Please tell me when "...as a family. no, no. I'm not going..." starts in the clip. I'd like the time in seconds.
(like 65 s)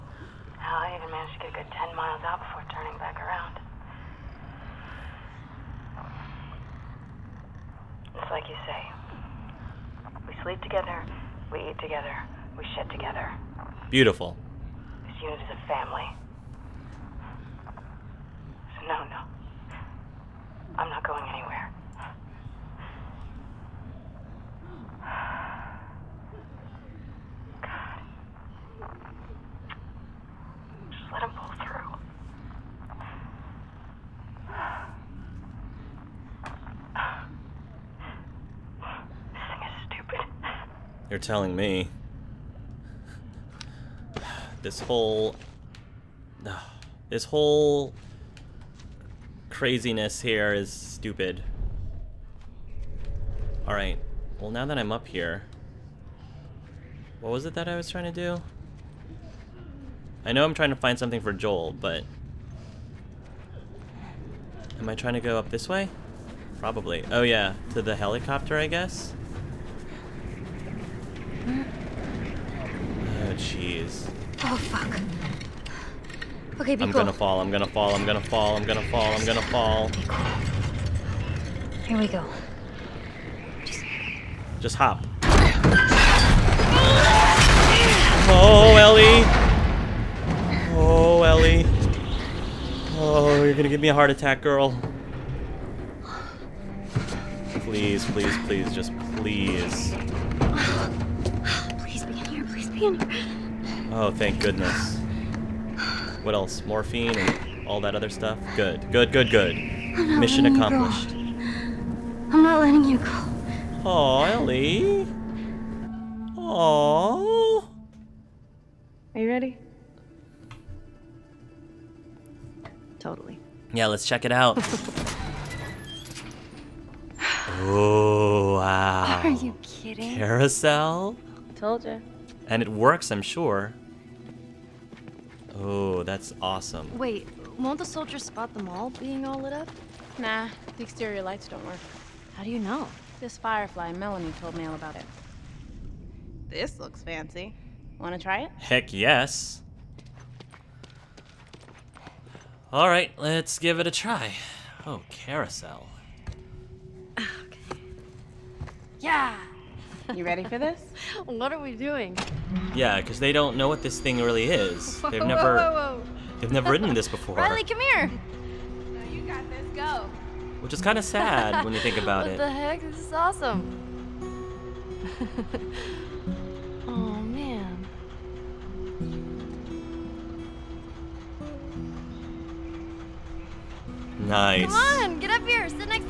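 15 s.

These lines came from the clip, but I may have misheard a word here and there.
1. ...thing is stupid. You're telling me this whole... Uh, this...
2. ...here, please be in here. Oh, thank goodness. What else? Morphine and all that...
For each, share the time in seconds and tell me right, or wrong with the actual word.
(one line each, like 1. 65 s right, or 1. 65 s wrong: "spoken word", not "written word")
1. 39 s right
2. 102 s right.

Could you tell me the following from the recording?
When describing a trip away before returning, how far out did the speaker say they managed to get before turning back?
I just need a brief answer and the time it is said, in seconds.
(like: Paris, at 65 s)
10 miles, at 1 s.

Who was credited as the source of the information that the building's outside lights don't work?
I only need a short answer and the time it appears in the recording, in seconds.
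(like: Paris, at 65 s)
Melanie, at 143 s.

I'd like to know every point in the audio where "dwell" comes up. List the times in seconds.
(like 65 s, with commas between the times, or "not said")
not said.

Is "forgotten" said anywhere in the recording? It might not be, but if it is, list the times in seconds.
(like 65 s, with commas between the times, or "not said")
not said.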